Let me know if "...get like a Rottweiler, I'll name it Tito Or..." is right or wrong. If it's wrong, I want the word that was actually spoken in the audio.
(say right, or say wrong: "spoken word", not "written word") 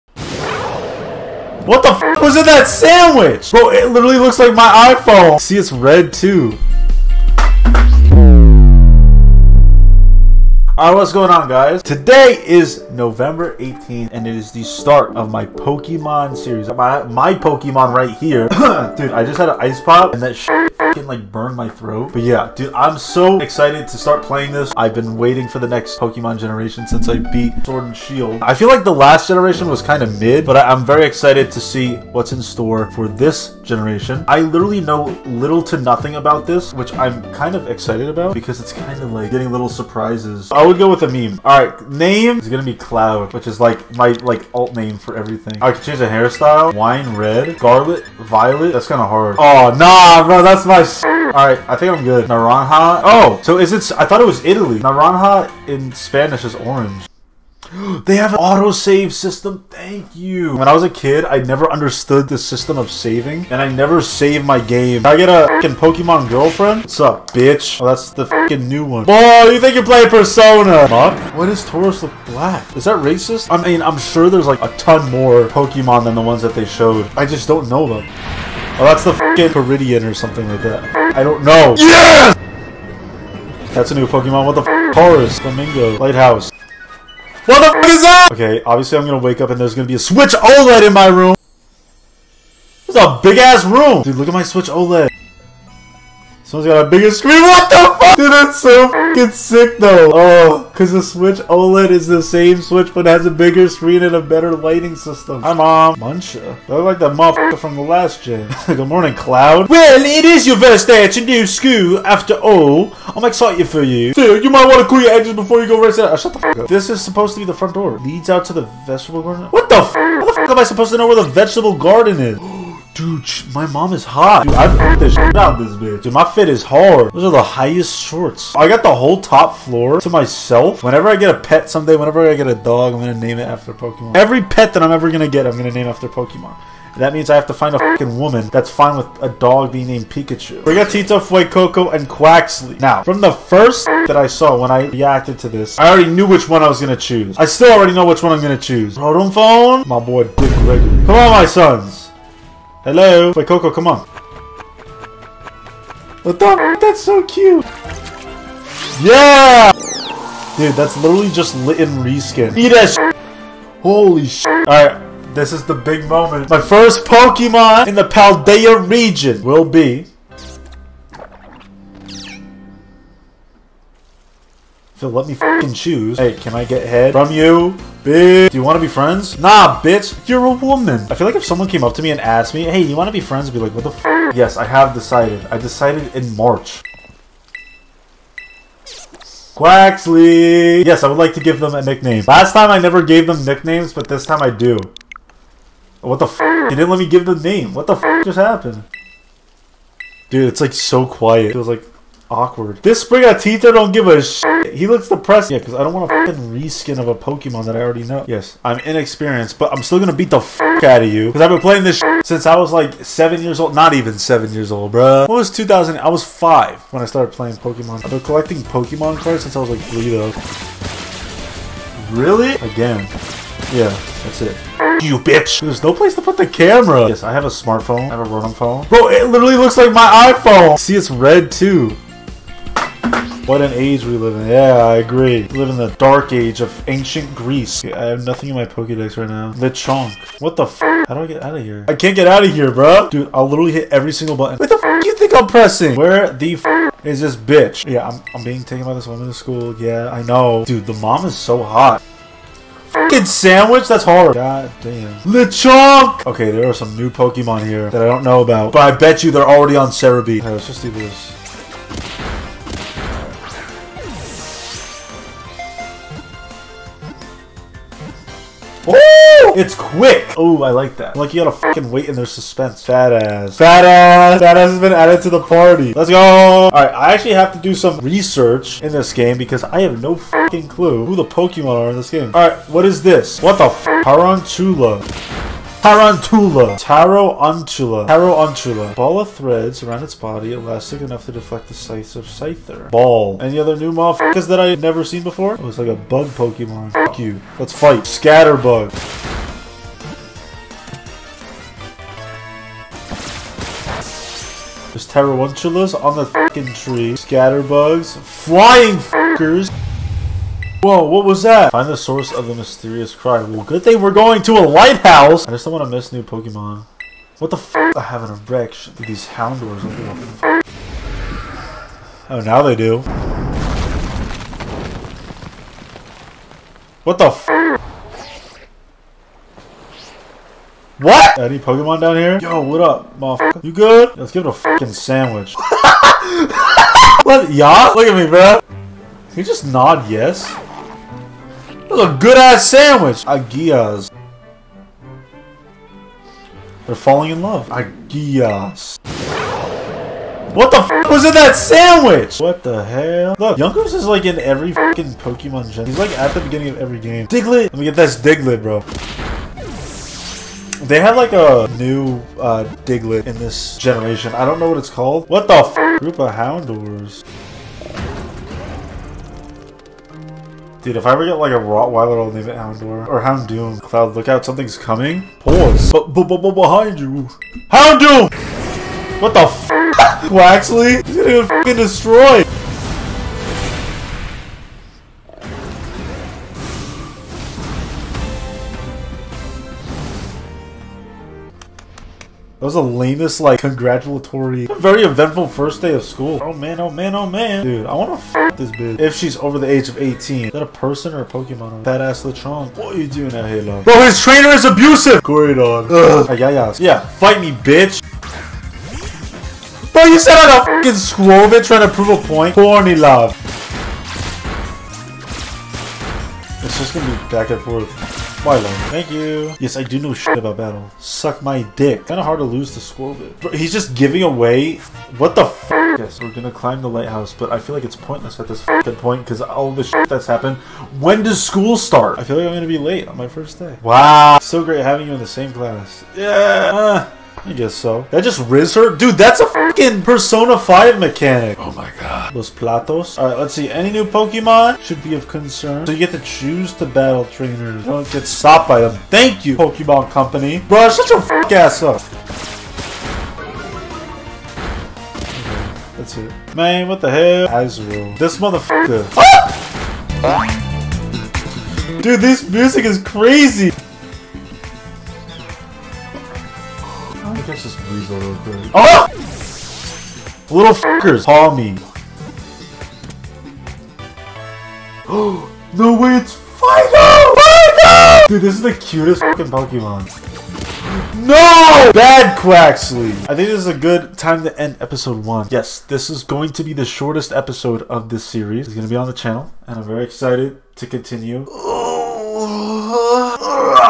wrong: "Houndour", not "Tito".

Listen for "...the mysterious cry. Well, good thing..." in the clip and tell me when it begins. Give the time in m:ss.
5:12.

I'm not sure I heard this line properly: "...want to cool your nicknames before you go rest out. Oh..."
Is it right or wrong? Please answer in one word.
wrong.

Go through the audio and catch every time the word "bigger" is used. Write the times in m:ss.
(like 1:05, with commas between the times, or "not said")
1:36, 1:43.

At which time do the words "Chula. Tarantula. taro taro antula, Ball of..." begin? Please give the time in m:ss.
4:44.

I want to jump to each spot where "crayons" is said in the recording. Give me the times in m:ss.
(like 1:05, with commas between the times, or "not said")
not said.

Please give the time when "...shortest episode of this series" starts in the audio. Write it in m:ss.
8:06.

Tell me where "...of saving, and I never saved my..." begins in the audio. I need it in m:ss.
1:02.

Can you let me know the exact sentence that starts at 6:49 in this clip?
Bro, you said I'm a fucking Scrovit trying to prove a point.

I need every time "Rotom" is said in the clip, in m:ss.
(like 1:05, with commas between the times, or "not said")
2:28, 3:48.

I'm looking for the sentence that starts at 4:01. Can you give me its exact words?
I can't get out of here, bro.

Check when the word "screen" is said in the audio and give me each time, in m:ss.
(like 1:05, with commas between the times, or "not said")
1:37, 1:43.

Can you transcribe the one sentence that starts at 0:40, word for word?
I would go with a meme.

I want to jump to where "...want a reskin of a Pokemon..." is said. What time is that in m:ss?
3:25.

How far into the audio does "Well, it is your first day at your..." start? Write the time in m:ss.
1:49.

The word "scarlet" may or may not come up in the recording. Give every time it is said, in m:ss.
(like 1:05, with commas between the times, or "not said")
0:47.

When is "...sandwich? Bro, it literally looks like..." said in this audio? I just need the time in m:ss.
0:02.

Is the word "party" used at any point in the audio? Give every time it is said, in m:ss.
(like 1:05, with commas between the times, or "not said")
4:35.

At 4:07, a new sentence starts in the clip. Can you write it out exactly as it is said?
Yeah, I'm, I'm being taken by this woman to school.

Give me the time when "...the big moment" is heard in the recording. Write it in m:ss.
2:45.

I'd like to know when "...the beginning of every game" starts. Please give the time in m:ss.
5:56.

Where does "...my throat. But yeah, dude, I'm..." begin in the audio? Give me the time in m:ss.
0:21.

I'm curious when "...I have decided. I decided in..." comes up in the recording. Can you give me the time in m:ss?
3:04.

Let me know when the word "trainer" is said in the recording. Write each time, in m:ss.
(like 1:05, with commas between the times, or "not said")
6:44, 7:27.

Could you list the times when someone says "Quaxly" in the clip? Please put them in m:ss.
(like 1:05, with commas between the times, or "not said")
2:22, 3:09, 6:19, 8:02.